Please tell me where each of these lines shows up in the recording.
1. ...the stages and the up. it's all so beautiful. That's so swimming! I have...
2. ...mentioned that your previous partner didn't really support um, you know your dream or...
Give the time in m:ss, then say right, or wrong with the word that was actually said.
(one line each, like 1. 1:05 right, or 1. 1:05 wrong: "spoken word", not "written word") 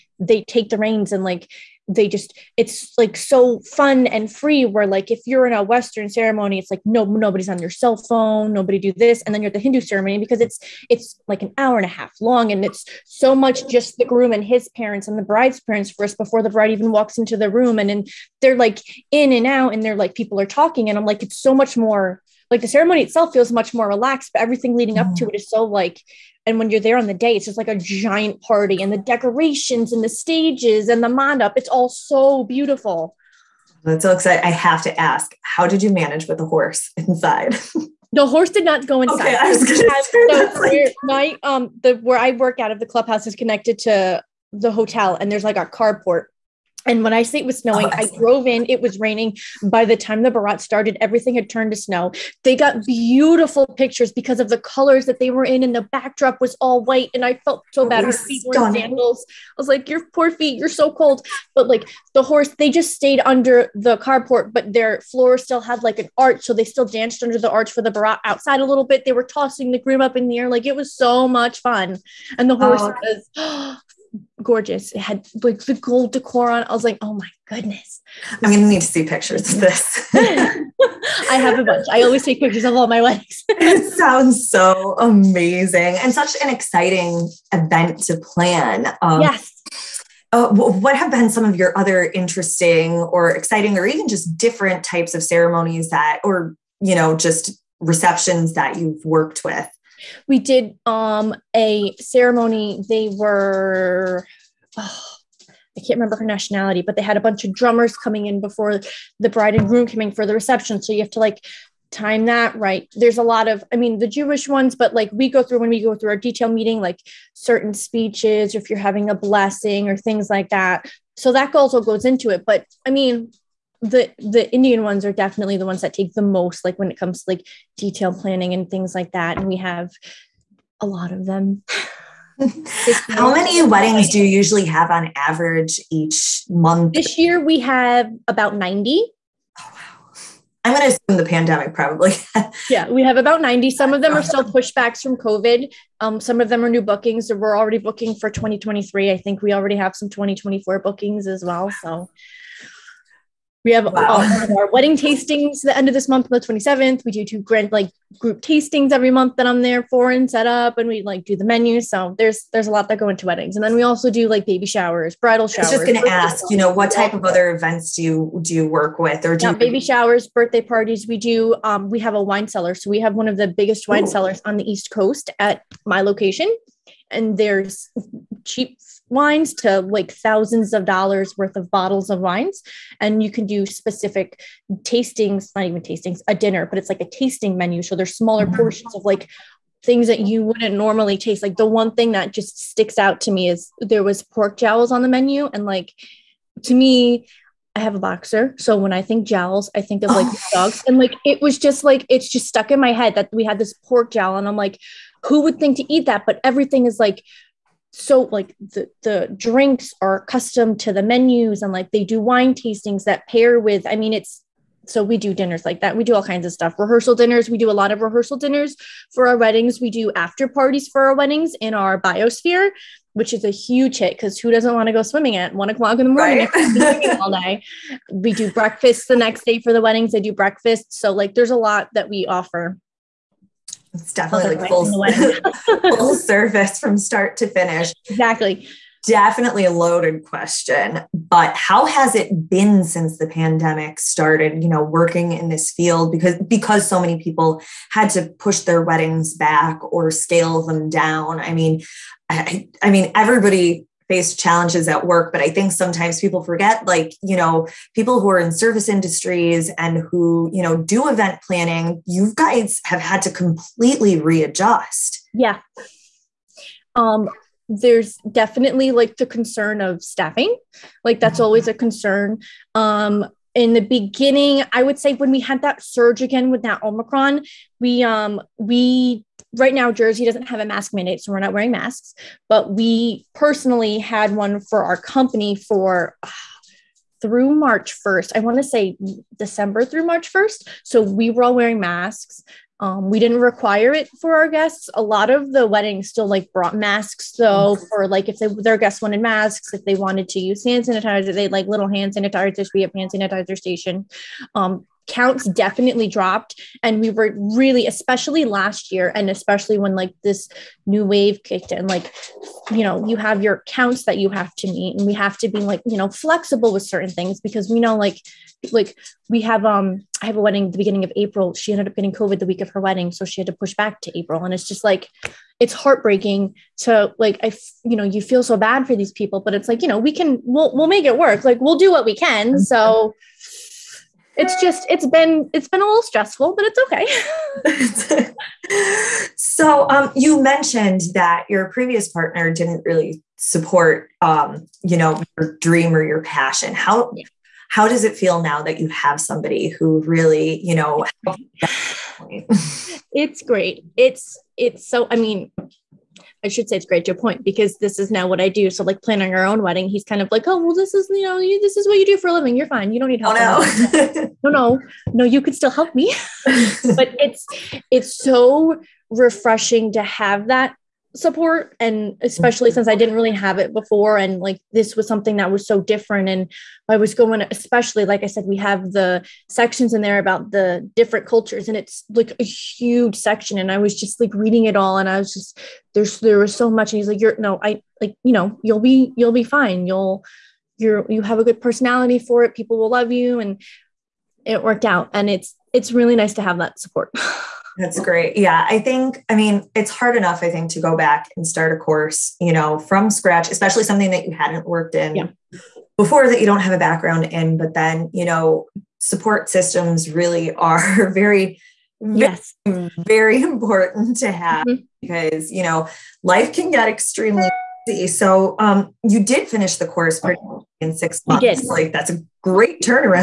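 1. 0:30 wrong: "exciting", not "swimming"
2. 5:40 right.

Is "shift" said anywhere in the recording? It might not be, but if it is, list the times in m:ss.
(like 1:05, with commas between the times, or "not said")
not said.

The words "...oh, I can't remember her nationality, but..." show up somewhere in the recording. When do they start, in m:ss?
1:44.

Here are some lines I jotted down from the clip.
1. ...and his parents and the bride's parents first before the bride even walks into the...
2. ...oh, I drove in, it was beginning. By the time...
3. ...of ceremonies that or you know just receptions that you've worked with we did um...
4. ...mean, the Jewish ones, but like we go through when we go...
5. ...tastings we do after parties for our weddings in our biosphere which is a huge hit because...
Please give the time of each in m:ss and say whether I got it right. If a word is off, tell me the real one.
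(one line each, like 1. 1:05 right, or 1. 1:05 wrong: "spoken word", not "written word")
1. 0:14 right
2. 0:47 wrong: "raining", not "beginning"
3. 1:35 right
4. 1:53 right
5. 3:39 wrong: "weddings", not "tastings".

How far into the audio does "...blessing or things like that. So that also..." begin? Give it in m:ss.
1:59.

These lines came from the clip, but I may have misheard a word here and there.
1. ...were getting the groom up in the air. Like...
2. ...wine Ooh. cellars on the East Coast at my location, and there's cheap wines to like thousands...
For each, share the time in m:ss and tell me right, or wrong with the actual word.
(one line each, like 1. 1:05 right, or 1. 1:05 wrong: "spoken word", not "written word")
1. 1:09 wrong: "tossing", not "getting"
2. 2:53 right.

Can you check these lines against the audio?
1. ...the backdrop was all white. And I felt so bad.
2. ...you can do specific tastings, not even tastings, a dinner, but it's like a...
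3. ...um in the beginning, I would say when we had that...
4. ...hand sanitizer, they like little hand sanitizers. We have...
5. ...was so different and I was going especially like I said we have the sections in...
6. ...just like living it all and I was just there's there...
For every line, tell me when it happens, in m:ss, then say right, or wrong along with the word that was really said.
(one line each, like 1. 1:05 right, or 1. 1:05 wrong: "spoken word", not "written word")
1. 0:55 right
2. 3:03 right
3. 4:32 right
4. 5:00 right
5. 6:15 right
6. 6:23 wrong: "reading", not "living".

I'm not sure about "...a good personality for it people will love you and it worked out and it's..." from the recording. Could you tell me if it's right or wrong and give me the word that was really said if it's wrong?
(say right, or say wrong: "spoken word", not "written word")
right.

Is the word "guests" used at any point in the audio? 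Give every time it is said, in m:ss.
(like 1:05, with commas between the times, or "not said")
4:54, 4:58.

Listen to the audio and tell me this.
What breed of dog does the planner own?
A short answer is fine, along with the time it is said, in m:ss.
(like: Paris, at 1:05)
boxer, at 3:18.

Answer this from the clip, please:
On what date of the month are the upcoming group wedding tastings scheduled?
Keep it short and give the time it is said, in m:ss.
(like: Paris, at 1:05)
27th, at 2:36.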